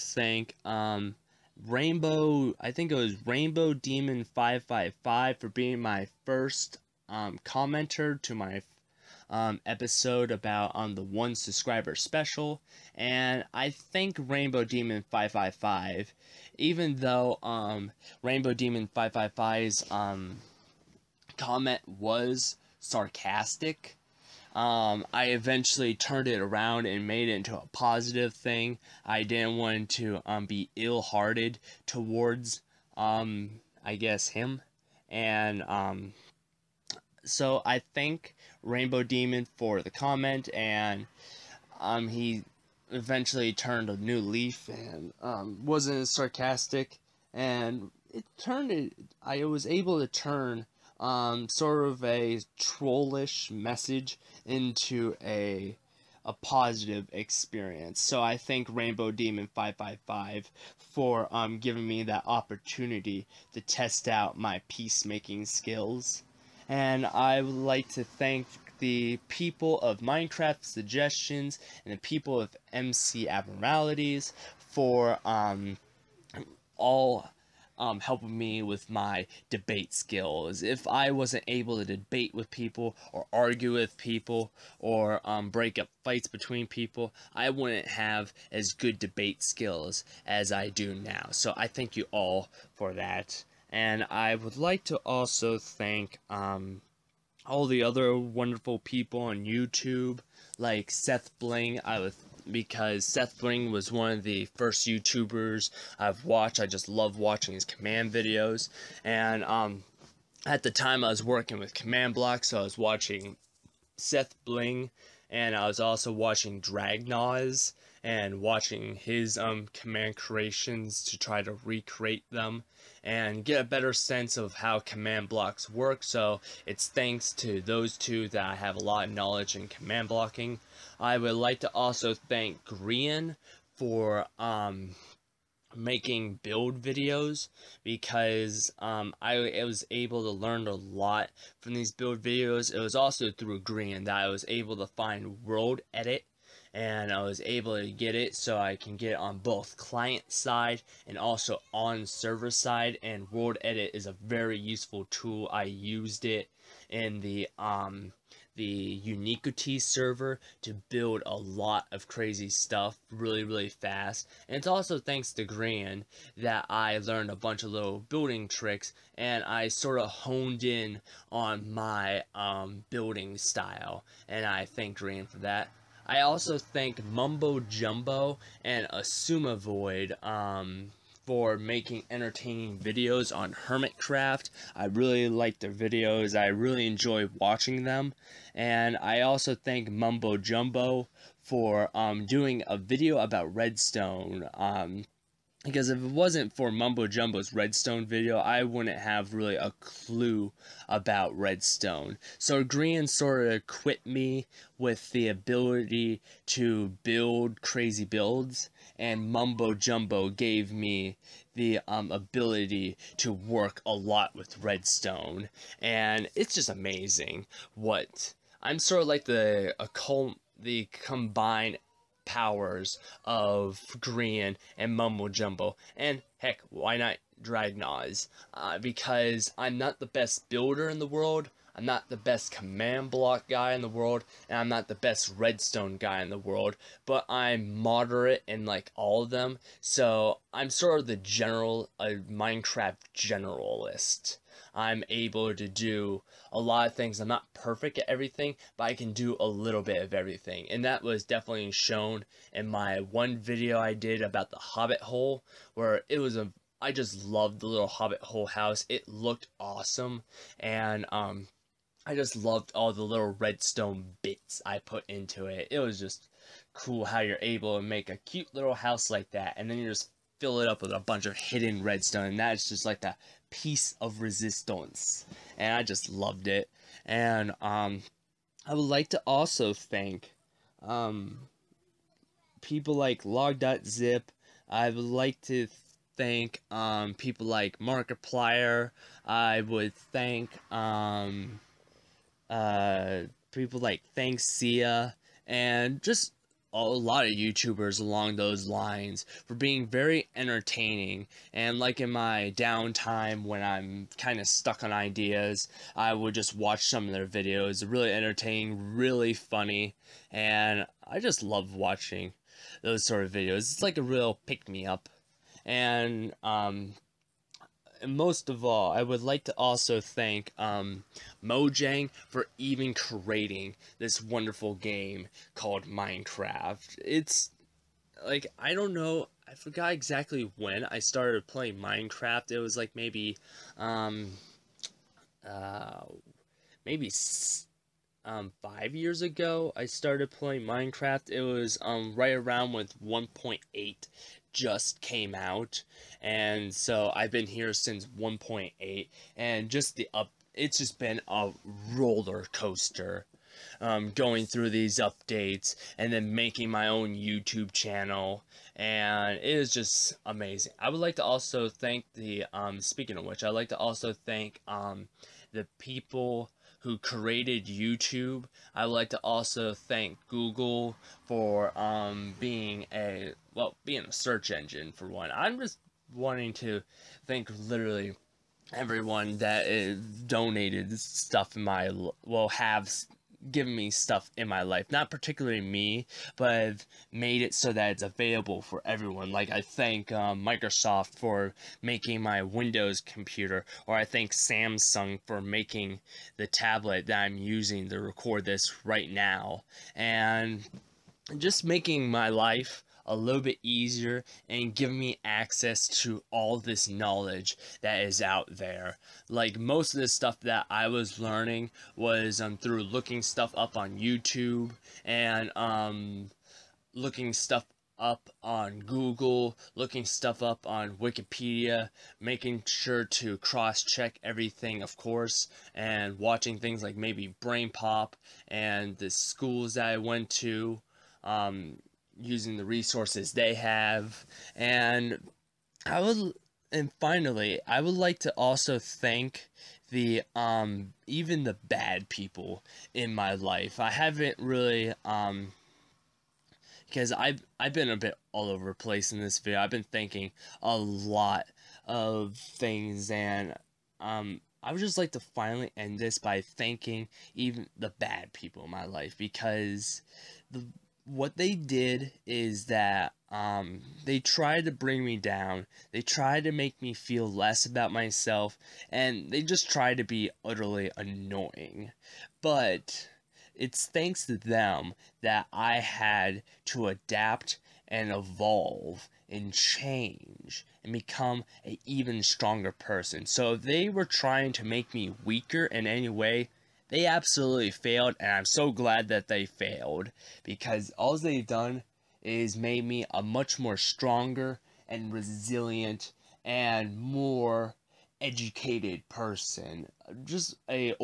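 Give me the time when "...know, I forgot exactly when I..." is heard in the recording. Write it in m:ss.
5:28.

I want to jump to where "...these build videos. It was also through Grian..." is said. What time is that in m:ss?
2:21.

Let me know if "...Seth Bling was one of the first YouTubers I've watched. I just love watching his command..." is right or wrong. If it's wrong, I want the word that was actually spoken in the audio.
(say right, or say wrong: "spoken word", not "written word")
right.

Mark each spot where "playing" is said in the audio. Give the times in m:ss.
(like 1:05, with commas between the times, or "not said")
5:31, 5:40.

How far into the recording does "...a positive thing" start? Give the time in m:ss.
0:27.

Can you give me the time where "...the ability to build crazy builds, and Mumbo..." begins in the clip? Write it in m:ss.
3:25.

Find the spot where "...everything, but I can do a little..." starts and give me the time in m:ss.
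4:08.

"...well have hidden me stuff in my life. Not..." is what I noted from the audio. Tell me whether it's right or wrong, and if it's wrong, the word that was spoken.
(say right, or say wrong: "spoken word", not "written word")
wrong: "given", not "hidden".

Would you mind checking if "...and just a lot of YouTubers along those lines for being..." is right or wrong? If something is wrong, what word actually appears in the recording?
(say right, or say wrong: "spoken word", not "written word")
right.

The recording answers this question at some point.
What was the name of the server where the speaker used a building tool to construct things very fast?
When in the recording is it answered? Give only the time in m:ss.
2:39.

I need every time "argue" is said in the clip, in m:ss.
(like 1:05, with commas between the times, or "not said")
1:23.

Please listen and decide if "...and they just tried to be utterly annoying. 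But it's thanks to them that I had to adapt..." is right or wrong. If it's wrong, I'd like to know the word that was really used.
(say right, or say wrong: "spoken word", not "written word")
right.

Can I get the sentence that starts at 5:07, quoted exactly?
Really entertaining, really funny, and I just love watching those sort of videos.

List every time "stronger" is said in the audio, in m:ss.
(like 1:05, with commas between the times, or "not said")
8:02, 8:13.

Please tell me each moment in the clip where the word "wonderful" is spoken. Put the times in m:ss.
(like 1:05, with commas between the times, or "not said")
1:38, 5:24.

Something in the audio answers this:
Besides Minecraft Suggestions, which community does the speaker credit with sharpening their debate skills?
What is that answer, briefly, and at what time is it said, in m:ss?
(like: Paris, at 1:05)
MC Abnormalities, at 1:12.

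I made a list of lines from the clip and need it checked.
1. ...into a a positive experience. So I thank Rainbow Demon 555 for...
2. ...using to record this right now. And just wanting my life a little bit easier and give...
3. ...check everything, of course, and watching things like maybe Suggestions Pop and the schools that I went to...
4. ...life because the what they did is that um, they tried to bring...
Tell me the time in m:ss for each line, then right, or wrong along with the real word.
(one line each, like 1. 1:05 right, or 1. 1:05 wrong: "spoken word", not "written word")
1. 0:54 right
2. 6:37 wrong: "making", not "wanting"
3. 7:03 wrong: "Brain", not "Suggestions"
4. 7:38 right.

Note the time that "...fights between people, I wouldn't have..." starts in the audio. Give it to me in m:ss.
1:26.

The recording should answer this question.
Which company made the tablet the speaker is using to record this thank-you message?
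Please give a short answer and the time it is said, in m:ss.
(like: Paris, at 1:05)
Samsung, at 6:34.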